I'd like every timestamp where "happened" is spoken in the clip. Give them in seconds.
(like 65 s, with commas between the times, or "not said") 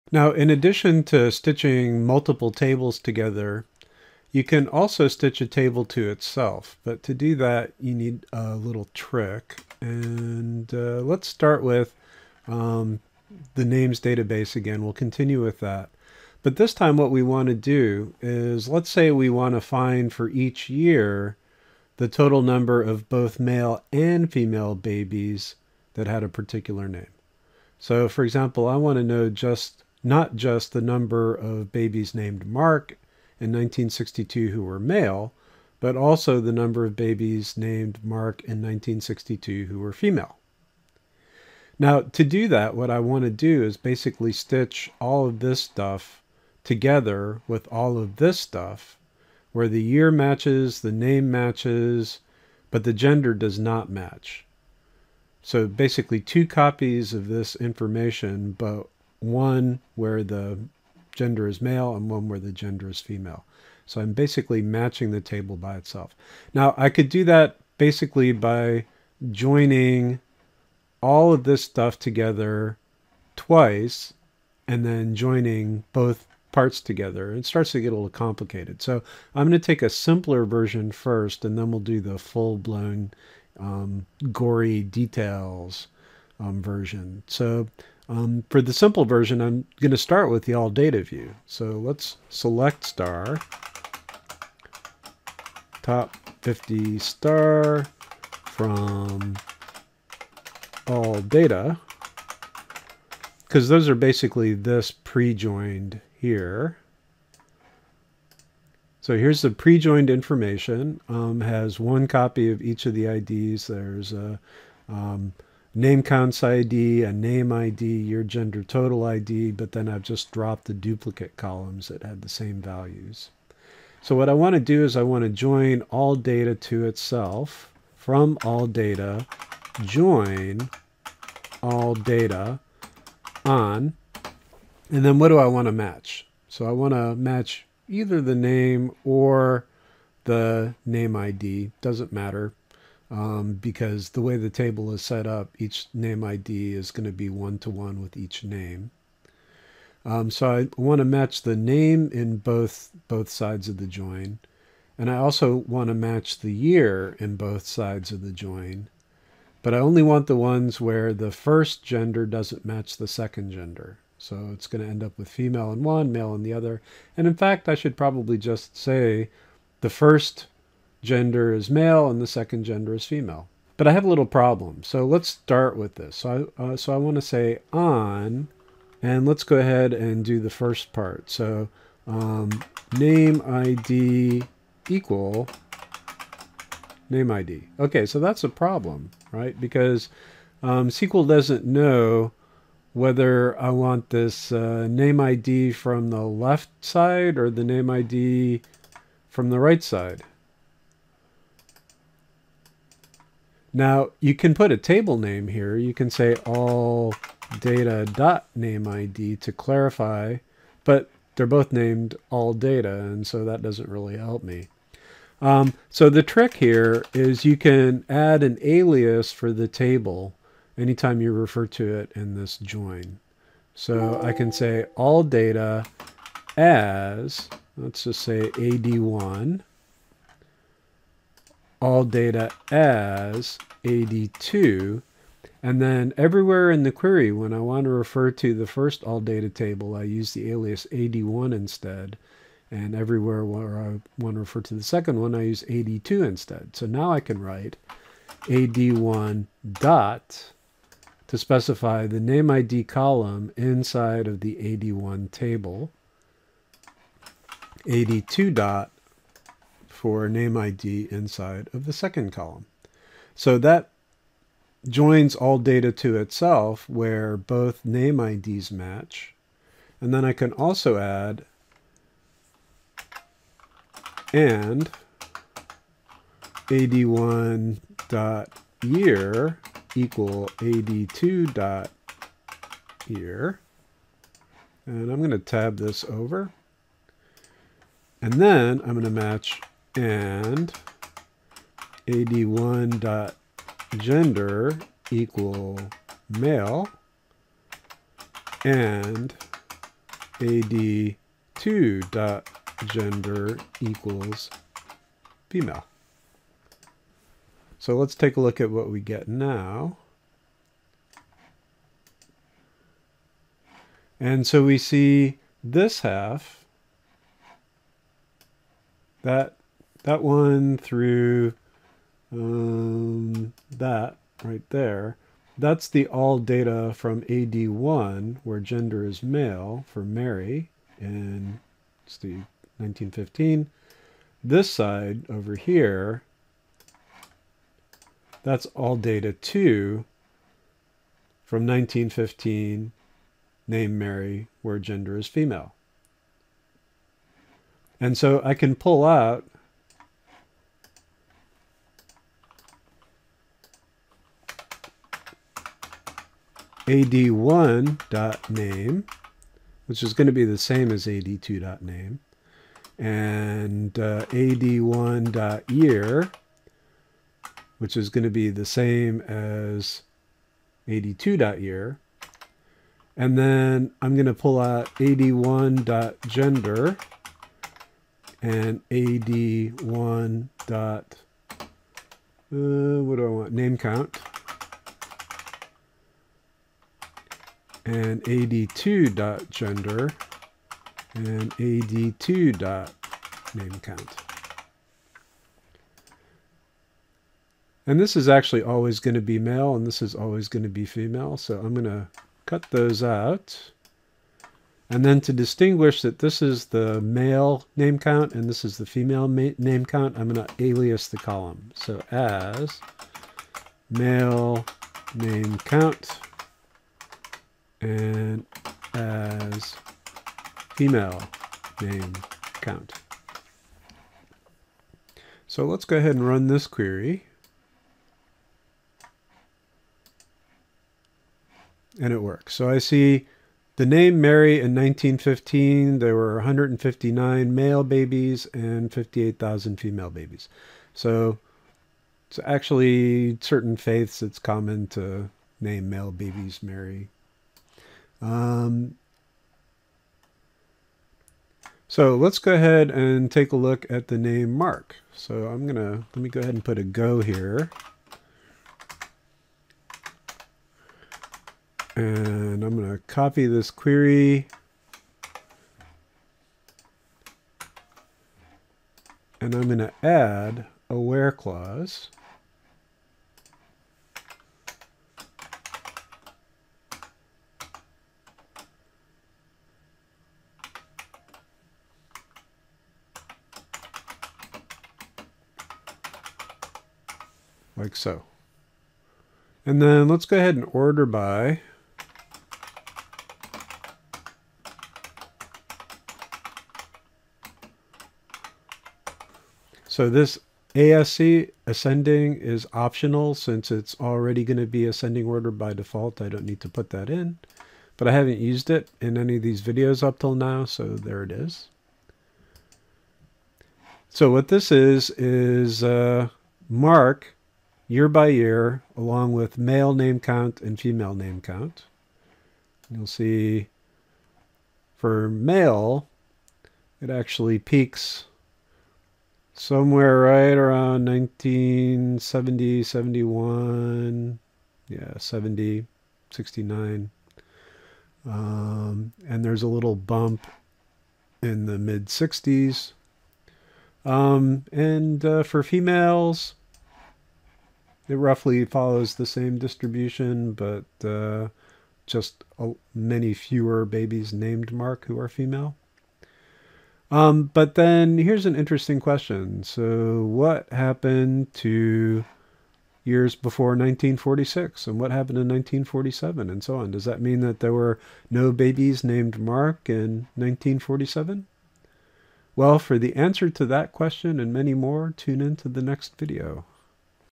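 560 s, 565 s.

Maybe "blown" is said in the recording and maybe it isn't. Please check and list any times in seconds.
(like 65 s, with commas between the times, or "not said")
82 s.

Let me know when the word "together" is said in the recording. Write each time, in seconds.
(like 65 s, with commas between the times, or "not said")
2 s, 46 s, 71 s, 76 s.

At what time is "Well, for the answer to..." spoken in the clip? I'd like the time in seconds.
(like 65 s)
572 s.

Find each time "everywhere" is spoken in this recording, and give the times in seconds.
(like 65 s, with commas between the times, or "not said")
236 s, 242 s.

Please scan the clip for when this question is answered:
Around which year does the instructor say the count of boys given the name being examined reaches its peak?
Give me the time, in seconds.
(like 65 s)
531 s.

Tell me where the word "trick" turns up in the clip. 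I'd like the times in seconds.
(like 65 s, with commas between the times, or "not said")
8 s, 216 s.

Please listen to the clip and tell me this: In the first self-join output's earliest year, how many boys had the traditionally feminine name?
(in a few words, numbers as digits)
159.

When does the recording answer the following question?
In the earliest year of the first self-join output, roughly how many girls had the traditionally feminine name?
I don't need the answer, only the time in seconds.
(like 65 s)
438 s.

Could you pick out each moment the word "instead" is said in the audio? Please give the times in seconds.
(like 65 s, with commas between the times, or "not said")
241 s, 246 s.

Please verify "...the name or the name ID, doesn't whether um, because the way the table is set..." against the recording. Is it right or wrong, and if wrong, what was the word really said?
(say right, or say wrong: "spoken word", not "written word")
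wrong: "matter", not "whether".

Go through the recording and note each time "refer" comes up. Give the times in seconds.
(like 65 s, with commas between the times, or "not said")
221 s, 237 s, 244 s.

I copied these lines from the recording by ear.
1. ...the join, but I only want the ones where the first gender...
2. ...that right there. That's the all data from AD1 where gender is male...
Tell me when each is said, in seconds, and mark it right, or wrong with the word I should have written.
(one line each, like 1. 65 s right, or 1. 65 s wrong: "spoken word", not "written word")
1. 158 s right
2. 323 s right.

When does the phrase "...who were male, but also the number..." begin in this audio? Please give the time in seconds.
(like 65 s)
34 s.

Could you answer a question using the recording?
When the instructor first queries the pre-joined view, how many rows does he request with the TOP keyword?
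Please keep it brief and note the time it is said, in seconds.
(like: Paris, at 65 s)
50, at 95 s.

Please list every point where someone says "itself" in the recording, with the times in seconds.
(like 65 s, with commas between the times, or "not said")
6 s, 65 s, 126 s, 266 s.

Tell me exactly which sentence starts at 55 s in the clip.
So basically two copies of this information, but one where the gender is male and one where the gender is female.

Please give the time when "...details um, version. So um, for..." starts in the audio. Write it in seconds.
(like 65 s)
84 s.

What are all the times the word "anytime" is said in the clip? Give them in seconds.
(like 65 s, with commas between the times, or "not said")
220 s.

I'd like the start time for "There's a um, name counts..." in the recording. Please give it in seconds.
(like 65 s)
113 s.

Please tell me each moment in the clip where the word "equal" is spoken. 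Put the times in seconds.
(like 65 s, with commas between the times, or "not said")
184 s, 279 s, 295 s, 303 s.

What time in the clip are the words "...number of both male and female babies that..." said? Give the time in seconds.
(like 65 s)
22 s.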